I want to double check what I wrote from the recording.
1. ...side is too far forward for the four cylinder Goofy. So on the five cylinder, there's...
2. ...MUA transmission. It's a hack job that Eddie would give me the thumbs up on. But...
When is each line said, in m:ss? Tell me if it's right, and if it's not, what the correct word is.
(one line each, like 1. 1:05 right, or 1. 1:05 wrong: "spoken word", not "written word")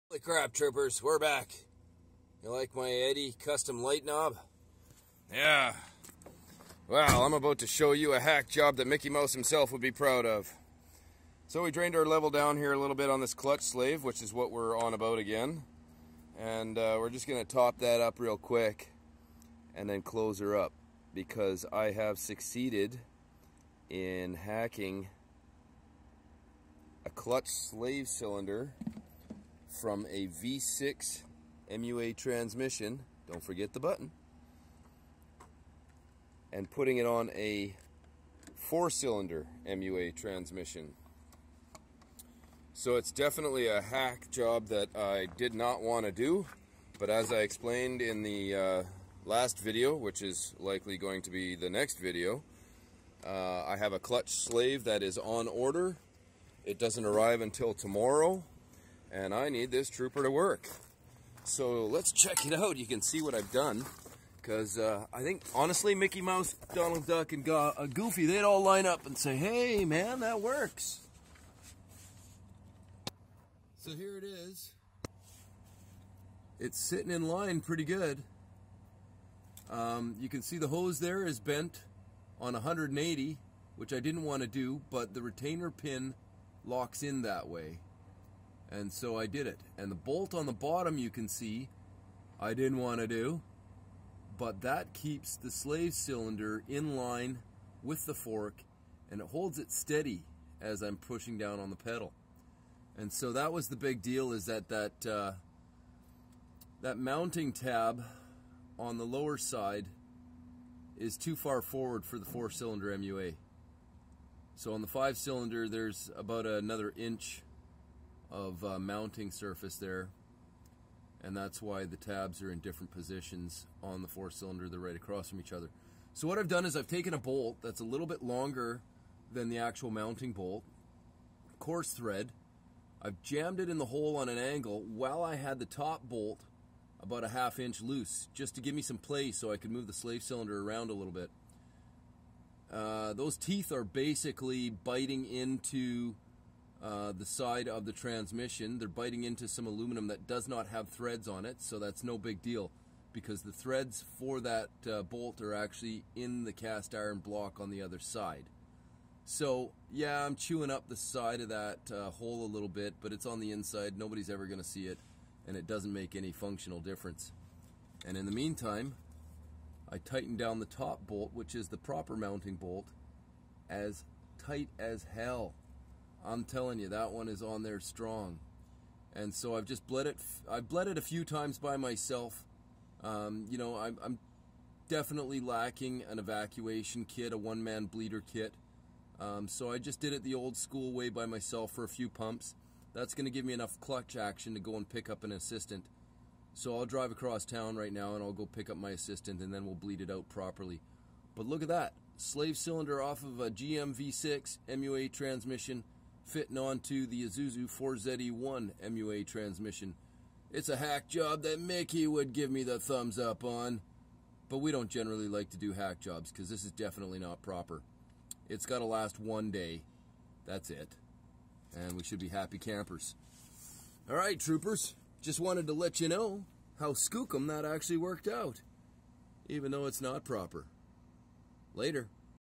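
1. 1:49 wrong: "MUA", not "Goofy"
2. 3:28 wrong: "Mickey", not "Eddie".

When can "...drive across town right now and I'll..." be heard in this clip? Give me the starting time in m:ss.
3:16.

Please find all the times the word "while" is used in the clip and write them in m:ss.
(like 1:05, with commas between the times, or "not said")
2:14.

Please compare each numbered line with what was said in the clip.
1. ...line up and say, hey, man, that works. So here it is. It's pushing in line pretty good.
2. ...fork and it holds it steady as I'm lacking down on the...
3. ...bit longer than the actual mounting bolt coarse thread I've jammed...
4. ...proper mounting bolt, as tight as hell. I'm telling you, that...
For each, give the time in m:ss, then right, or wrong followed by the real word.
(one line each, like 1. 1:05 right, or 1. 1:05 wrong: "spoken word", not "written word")
1. 1:08 wrong: "sitting", not "pushing"
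2. 1:38 wrong: "pushing", not "lacking"
3. 2:08 right
4. 2:51 right.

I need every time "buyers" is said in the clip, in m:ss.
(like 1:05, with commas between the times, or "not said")
not said.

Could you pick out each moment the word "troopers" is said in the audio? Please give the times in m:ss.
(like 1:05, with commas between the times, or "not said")
0:00, 0:59, 3:44.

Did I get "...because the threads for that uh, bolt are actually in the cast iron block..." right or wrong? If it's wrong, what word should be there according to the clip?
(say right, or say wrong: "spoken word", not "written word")
right.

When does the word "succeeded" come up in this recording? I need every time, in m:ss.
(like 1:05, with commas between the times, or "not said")
0:22.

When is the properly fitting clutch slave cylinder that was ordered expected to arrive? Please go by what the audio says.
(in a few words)
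Tomorrow.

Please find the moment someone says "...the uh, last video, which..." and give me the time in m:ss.
0:48.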